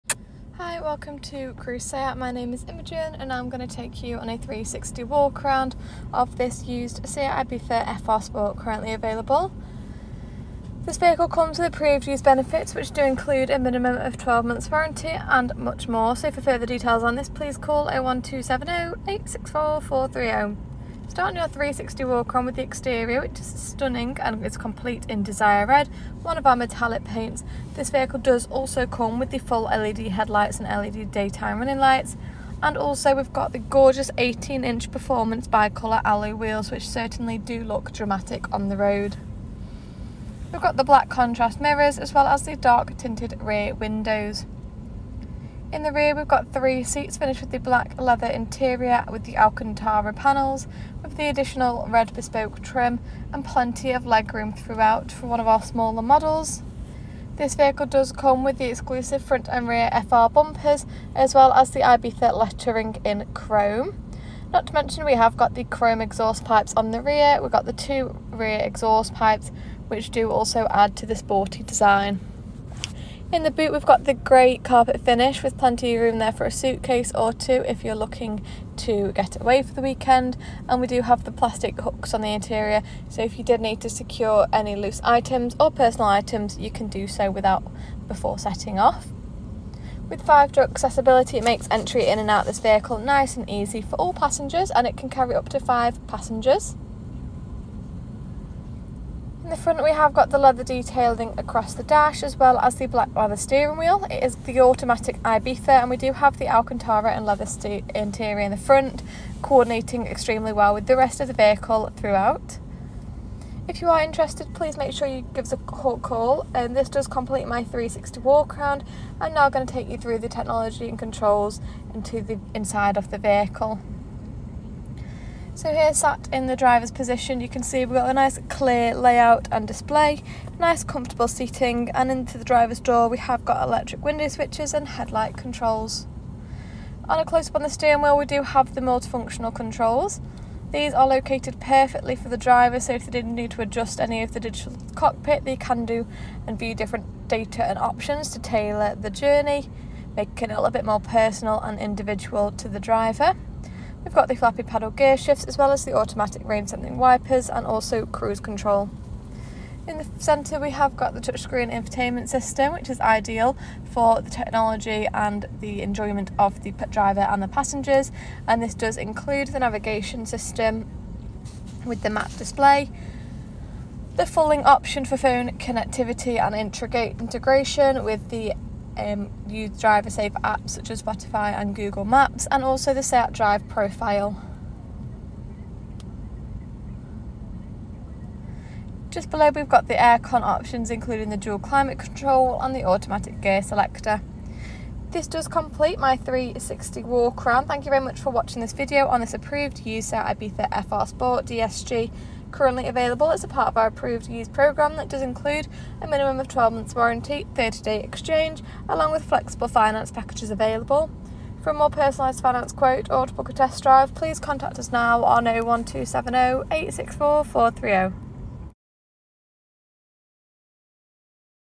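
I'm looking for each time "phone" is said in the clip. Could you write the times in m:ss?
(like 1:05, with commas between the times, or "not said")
2:55.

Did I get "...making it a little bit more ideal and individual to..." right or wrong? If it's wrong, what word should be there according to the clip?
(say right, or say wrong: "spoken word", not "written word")
wrong: "personal", not "ideal".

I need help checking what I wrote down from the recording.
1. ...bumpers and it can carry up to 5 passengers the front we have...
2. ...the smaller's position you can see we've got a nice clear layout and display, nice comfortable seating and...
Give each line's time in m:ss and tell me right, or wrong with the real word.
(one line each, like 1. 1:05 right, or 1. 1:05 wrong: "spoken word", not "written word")
1. 1:34 wrong: "passengers", not "bumpers"
2. 2:06 wrong: "driver", not "smaller".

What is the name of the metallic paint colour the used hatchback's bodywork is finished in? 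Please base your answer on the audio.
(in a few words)
Desire Red.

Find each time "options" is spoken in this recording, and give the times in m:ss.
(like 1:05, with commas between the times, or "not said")
2:27, 2:54, 3:10.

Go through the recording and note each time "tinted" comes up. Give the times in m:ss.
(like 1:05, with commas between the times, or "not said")
0:42.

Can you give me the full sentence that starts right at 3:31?
For a more personalised finance quote or to book a test drive, please contact us now on 01270 864 430.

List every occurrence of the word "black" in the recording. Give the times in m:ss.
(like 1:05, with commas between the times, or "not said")
0:40, 0:47, 1:42.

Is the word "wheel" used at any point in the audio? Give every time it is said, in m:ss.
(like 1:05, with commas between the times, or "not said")
0:36, 1:43, 2:18.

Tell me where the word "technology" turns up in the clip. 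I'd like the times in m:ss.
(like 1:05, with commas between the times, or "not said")
2:00, 2:44.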